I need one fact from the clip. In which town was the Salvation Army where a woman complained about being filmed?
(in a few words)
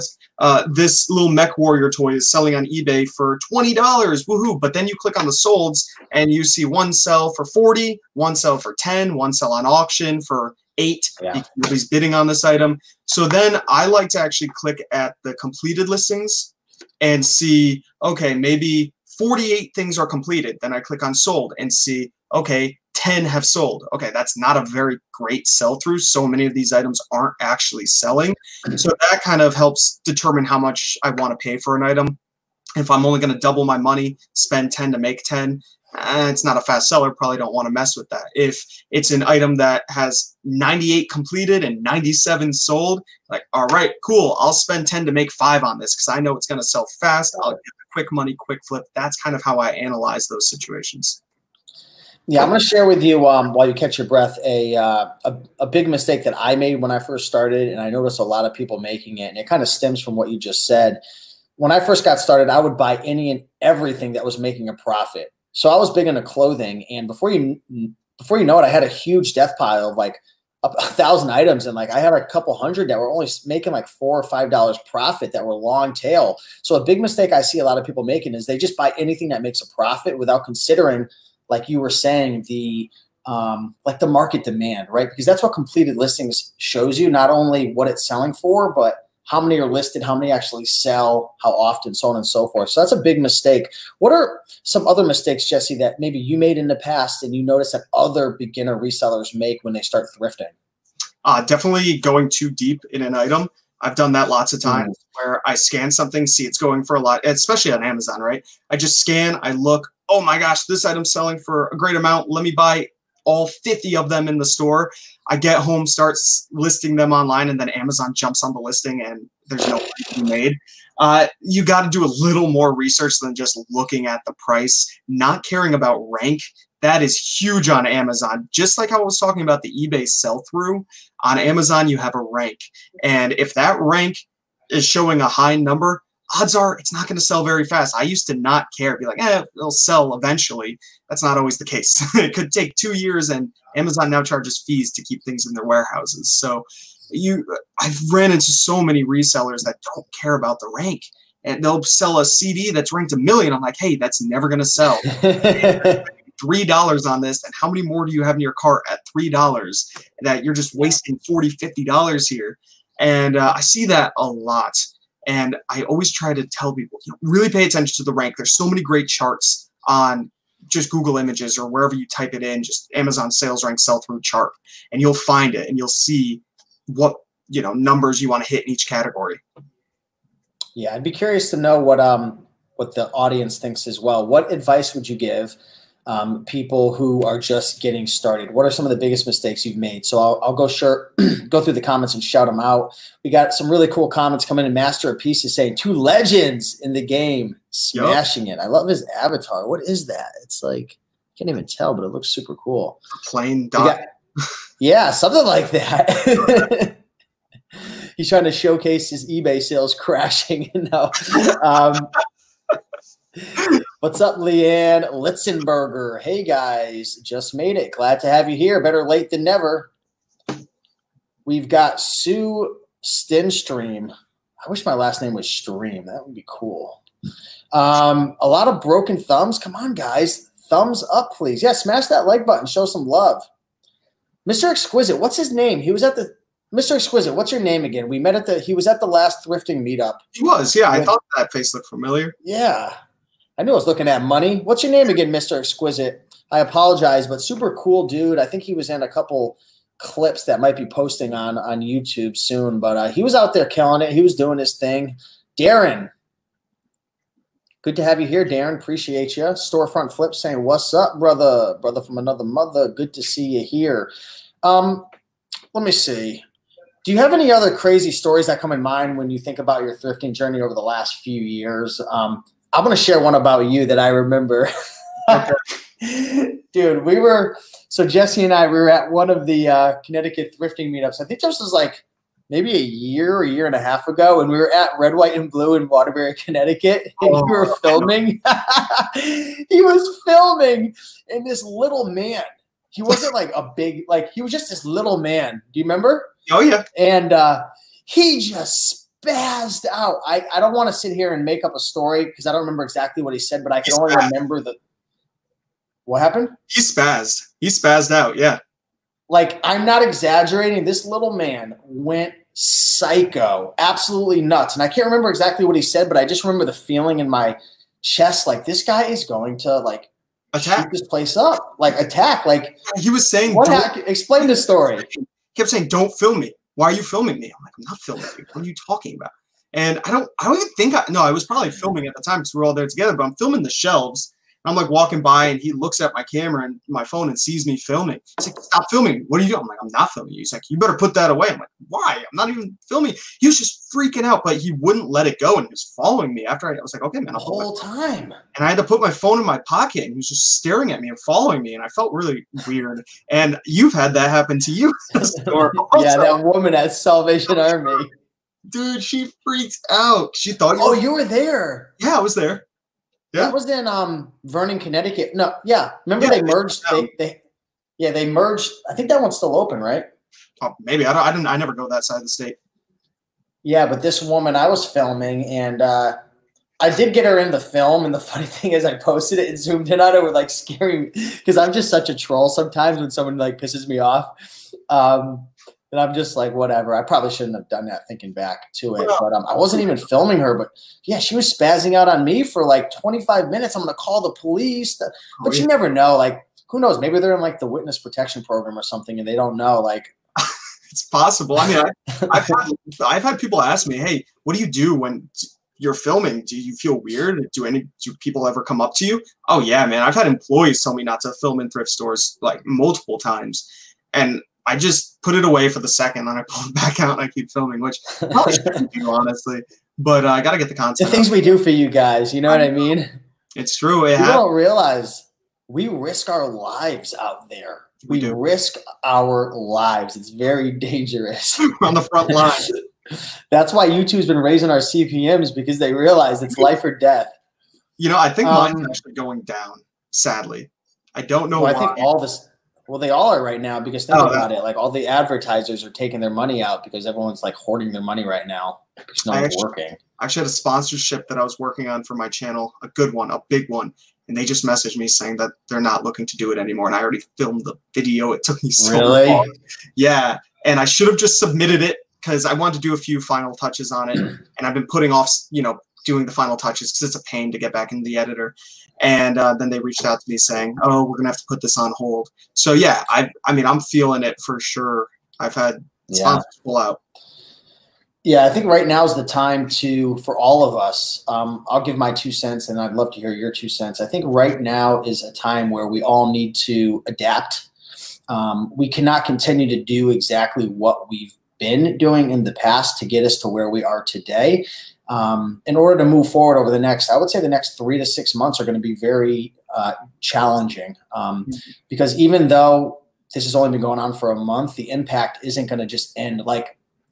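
Vernon.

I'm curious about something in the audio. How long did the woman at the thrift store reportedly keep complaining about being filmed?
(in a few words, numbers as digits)
25 minutes.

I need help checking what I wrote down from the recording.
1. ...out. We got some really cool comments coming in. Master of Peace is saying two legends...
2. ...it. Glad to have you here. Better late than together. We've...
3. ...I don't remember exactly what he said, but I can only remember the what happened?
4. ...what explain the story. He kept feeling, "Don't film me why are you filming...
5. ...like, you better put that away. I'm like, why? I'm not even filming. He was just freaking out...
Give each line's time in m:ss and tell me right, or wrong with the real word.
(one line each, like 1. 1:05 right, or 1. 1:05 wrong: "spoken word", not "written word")
1. 3:12 right
2. 3:37 wrong: "never", not "together"
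3. 5:02 right
4. 5:23 wrong: "saying", not "feeling"
5. 5:40 right.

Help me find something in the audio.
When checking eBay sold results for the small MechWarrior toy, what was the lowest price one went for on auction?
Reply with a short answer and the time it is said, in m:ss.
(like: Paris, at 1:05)
$8, at 0:10.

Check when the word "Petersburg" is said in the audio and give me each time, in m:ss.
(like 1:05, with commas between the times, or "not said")
not said.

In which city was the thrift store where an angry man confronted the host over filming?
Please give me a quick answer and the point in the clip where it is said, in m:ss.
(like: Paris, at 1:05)
Waterbury, at 4:45.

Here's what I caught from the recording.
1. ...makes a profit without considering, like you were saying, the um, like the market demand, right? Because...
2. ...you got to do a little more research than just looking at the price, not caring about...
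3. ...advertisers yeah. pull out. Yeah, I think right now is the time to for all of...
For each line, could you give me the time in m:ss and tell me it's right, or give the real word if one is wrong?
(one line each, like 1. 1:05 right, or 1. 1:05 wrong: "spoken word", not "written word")
1. 1:19 right
2. 2:01 right
3. 7:56 wrong: "sponsors", not "advertisers".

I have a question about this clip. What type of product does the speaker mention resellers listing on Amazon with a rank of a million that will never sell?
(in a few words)
CD.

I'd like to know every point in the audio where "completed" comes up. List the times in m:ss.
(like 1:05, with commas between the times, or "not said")
0:15, 0:20, 0:41, 1:25.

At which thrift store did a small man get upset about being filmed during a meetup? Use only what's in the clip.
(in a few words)
Red, White, and Blue.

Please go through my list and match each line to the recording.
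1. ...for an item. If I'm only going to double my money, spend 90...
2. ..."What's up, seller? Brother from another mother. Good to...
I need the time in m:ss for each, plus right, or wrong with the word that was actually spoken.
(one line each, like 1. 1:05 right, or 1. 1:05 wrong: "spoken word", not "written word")
1. 0:31 wrong: "10", not "90"
2. 4:20 wrong: "brother", not "seller".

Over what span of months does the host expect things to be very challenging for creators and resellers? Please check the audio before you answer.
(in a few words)
3 to 6 months.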